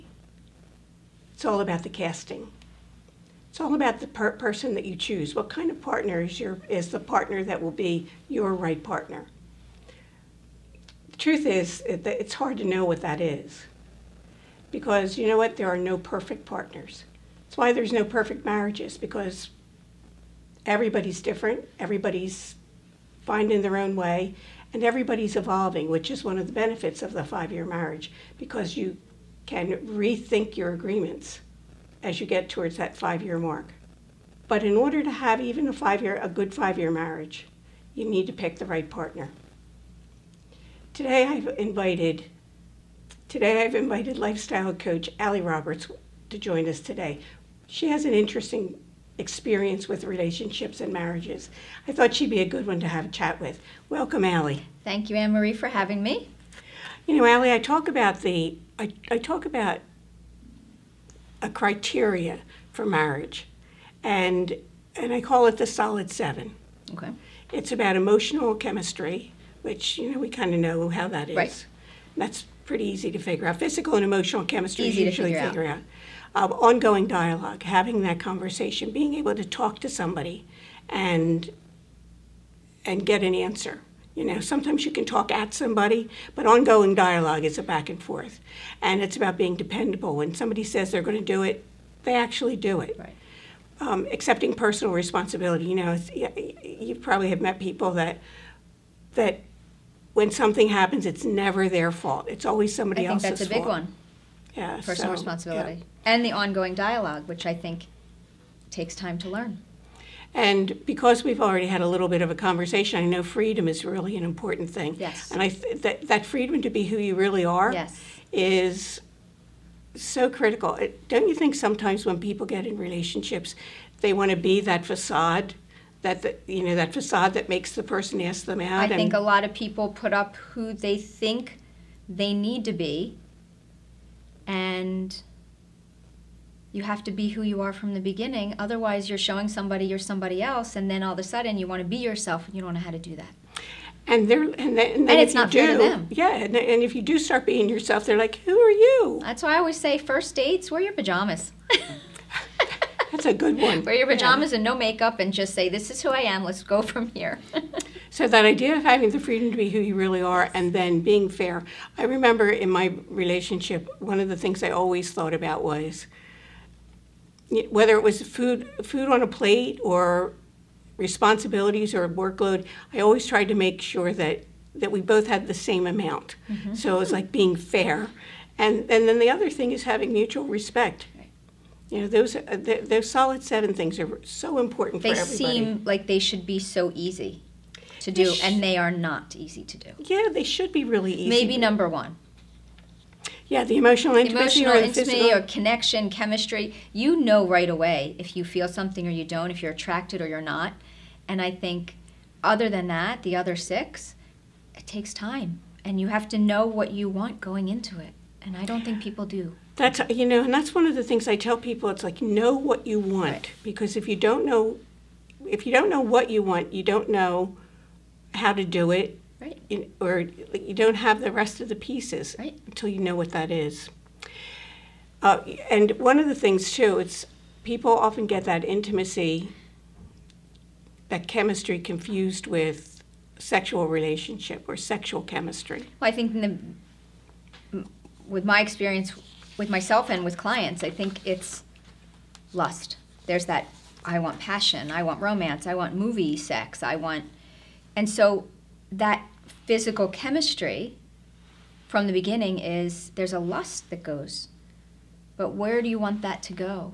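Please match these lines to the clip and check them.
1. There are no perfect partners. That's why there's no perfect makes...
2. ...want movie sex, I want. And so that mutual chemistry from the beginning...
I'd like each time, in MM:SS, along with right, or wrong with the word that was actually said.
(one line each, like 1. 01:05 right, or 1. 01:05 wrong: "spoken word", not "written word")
1. 00:15 wrong: "marriages", not "makes"
2. 04:05 wrong: "physical", not "mutual".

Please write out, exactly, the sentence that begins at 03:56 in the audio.
Well, I think the, with my experience with myself and with clients, I think it's lust.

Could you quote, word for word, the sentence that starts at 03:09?
Yeah, they should be really easy.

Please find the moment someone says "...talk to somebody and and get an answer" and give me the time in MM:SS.
01:19.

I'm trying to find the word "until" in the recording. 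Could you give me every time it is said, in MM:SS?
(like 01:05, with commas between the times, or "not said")
03:42.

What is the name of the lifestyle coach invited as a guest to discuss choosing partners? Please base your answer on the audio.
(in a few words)
Allie Roberts.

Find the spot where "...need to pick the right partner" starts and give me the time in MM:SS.
00:38.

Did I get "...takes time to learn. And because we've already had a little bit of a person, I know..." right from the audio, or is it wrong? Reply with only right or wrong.
wrong.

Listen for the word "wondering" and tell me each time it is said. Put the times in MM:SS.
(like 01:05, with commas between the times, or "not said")
not said.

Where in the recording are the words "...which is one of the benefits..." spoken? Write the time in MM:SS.
00:25.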